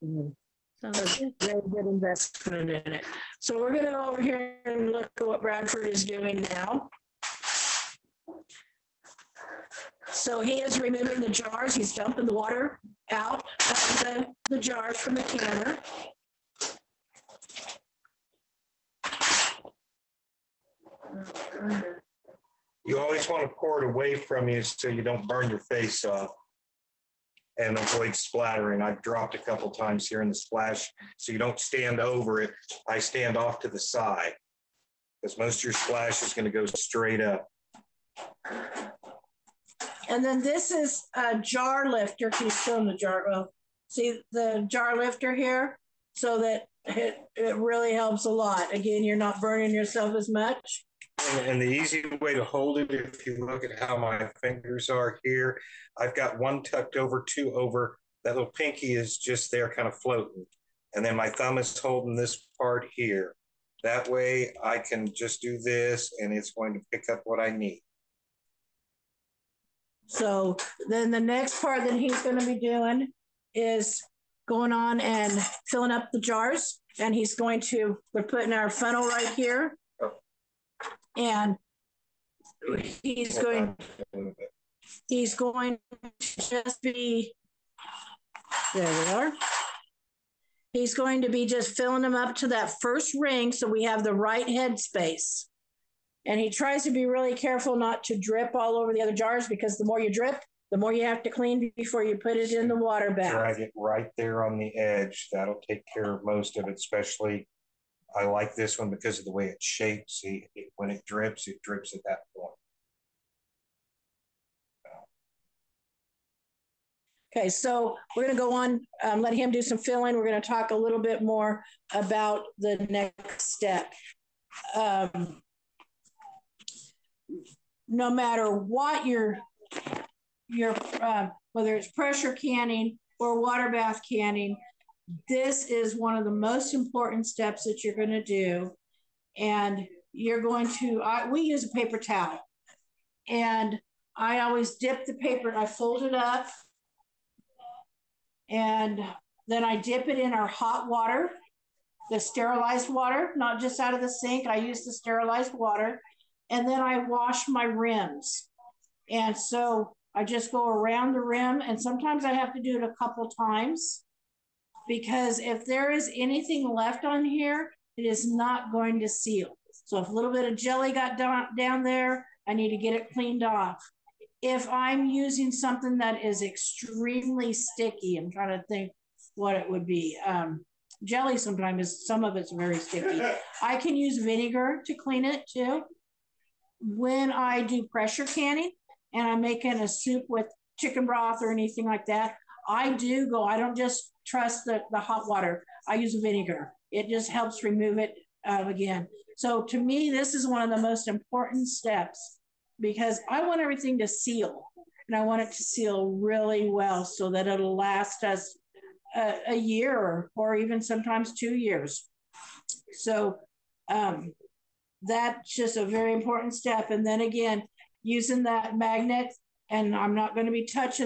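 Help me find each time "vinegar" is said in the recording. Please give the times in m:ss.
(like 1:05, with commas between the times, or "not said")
3:04, 3:16.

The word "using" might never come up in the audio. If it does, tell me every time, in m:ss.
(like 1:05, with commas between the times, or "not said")
2:55, 3:38.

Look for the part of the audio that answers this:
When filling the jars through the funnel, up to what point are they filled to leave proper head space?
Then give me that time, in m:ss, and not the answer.
1:32.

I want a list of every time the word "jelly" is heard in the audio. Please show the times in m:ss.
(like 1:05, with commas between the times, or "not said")
2:50, 3:01.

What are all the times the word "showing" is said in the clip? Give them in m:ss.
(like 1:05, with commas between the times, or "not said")
0:42.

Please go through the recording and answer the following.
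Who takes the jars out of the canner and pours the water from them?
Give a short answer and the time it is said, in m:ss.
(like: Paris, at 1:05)
Bradford, at 0:05.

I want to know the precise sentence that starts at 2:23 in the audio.
And I always dip the paper, I fold it up.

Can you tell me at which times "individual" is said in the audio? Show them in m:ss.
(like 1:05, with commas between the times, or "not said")
not said.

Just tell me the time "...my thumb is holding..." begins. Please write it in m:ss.
1:01.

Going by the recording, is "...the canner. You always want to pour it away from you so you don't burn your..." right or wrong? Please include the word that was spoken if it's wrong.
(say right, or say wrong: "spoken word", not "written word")
right.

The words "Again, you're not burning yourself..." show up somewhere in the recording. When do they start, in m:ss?
0:48.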